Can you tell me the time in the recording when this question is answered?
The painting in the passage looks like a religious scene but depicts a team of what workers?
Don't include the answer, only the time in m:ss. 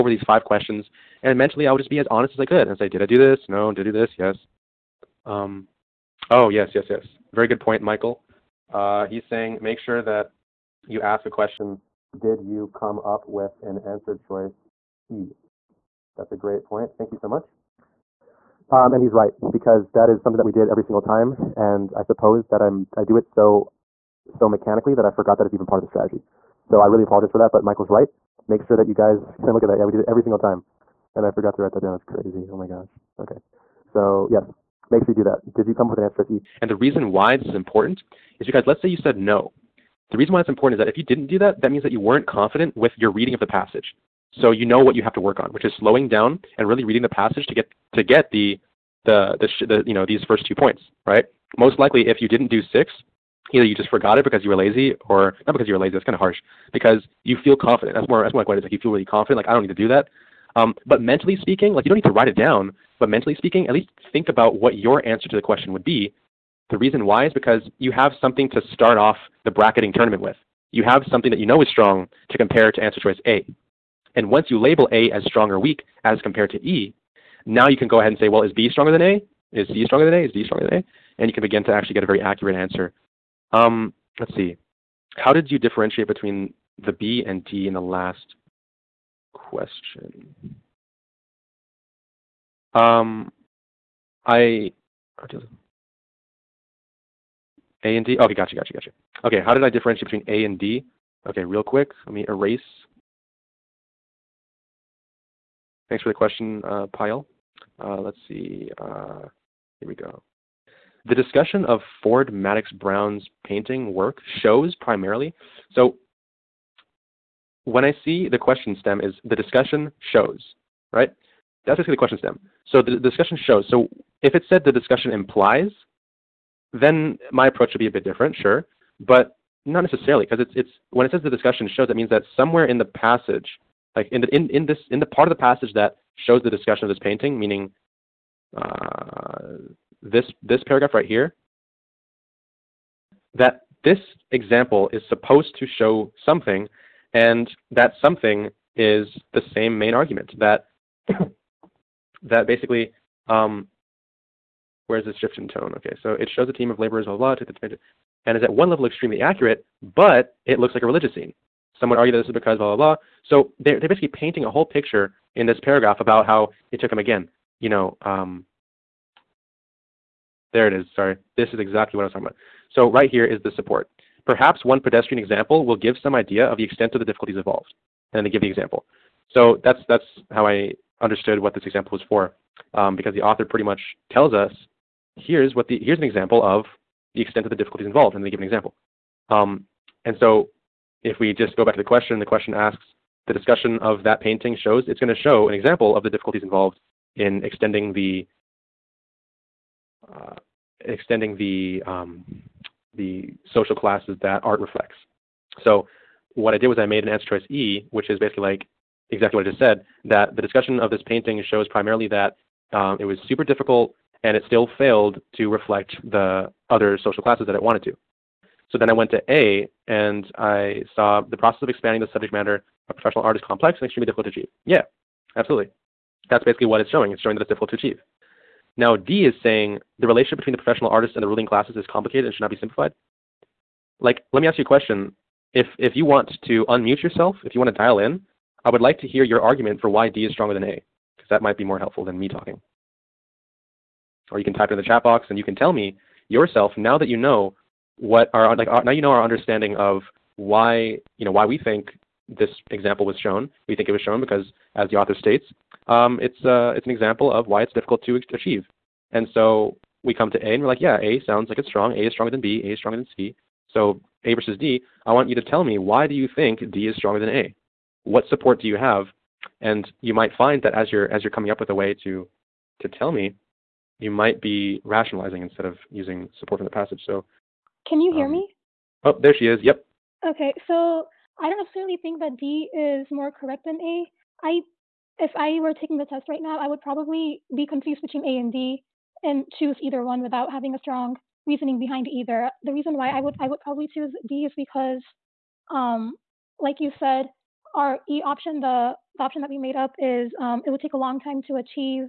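2:36.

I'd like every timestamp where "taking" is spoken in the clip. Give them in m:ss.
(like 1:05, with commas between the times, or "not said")
4:45.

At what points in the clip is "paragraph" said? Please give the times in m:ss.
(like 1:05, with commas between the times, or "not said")
2:20, 2:45.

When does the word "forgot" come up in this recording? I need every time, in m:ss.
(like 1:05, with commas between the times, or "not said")
0:25, 0:31, 0:53.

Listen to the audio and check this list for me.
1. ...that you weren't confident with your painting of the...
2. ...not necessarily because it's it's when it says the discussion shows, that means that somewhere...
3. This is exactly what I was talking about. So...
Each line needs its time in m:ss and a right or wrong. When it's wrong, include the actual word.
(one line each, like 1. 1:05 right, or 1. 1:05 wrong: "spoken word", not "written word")
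1. 0:41 wrong: "reading", not "painting"
2. 2:09 right
3. 2:51 right.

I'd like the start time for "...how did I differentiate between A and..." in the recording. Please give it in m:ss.
1:39.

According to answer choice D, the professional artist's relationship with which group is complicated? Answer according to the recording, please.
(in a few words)
the ruling classes.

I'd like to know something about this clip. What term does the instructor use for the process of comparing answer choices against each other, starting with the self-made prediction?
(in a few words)
bracketing tournament.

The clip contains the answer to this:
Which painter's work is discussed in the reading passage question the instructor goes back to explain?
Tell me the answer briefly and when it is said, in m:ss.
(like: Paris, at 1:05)
Ford Madox Brown, at 1:52.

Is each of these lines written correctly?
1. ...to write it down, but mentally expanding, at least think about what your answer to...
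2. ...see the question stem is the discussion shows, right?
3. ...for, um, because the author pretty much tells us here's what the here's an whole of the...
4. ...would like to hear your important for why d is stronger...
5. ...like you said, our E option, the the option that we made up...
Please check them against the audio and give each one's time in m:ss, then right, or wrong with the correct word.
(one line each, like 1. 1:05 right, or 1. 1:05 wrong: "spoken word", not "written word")
1. 1:02 wrong: "speaking", not "expanding"
2. 1:58 right
3. 3:02 wrong: "example", not "whole"
4. 3:58 wrong: "argument", not "important"
5. 4:56 right.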